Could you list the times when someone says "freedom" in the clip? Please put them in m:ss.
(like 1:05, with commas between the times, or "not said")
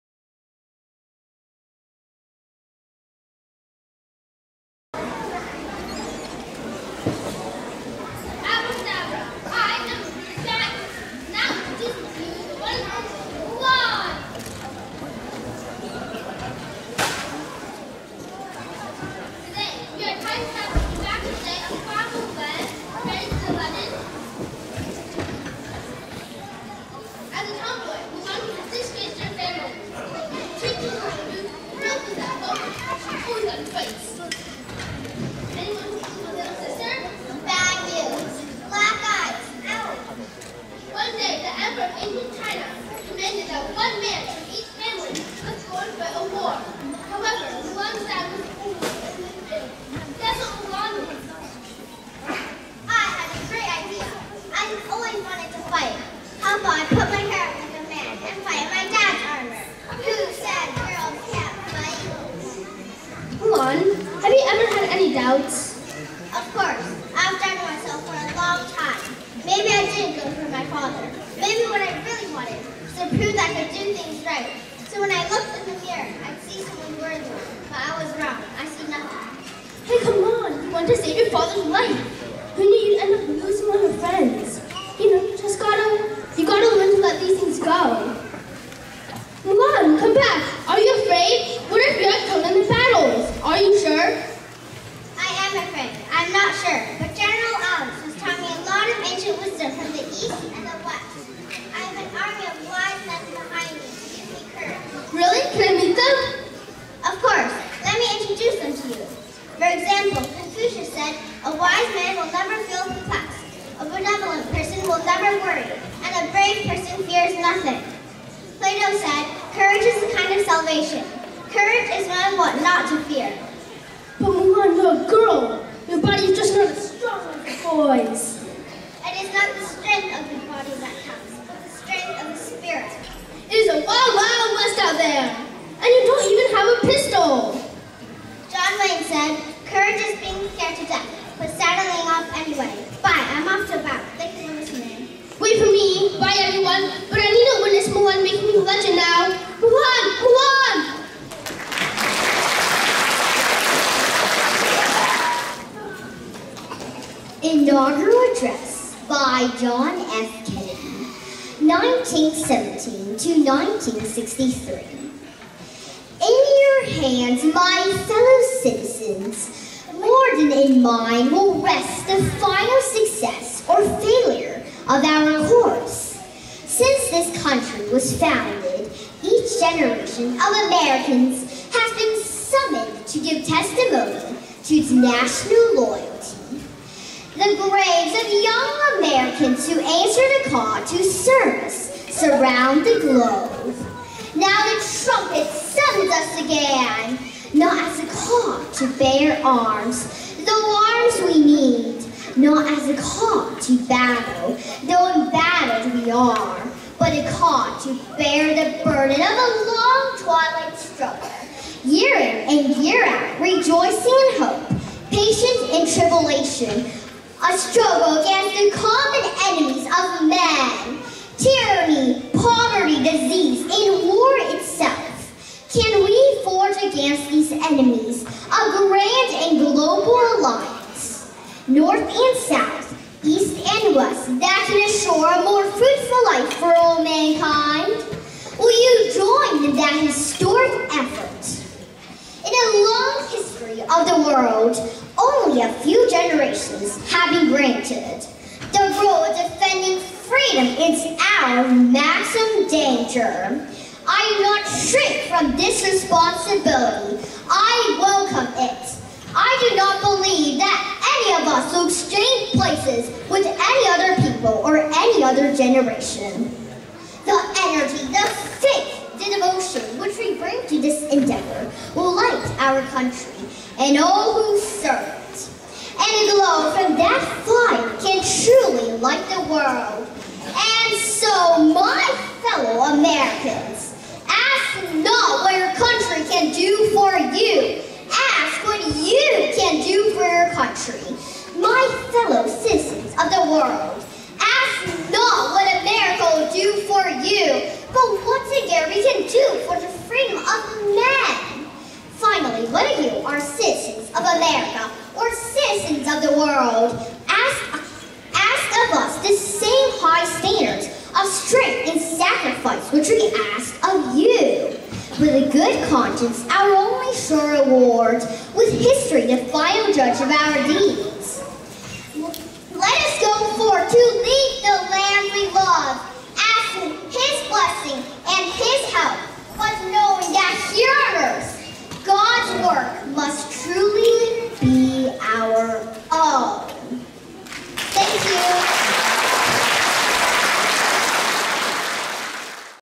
4:10, 5:00.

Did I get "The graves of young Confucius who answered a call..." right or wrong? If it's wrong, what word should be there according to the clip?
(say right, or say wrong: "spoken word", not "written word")
wrong: "Americans", not "Confucius".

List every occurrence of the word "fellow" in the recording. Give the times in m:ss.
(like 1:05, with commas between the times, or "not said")
2:48, 4:52.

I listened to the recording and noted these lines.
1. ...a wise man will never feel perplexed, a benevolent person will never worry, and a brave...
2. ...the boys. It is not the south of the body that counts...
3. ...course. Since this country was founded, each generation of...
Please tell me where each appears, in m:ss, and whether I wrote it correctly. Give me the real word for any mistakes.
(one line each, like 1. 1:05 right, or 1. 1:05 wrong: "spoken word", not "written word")
1. 1:51 right
2. 2:07 wrong: "strength", not "south"
3. 2:55 right.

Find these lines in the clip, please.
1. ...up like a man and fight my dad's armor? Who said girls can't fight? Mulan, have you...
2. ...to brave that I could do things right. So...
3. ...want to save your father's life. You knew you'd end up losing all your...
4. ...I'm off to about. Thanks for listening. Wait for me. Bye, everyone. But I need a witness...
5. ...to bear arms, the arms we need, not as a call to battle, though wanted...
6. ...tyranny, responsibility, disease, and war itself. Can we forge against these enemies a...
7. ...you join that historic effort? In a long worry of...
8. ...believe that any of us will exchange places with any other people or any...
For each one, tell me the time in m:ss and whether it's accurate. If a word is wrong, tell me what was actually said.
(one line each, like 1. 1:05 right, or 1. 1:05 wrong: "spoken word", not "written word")
1. 0:57 right
2. 1:13 wrong: "prove", not "brave"
3. 1:20 right
4. 2:23 right
5. 3:18 wrong: "embattled", not "wanted"
6. 3:41 wrong: "poverty", not "responsibility"
7. 3:58 wrong: "history", not "worry"
8. 4:20 right.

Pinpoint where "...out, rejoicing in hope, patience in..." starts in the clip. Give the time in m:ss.
3:33.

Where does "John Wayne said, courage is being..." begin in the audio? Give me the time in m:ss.
2:18.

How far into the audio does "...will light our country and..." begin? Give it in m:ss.
4:31.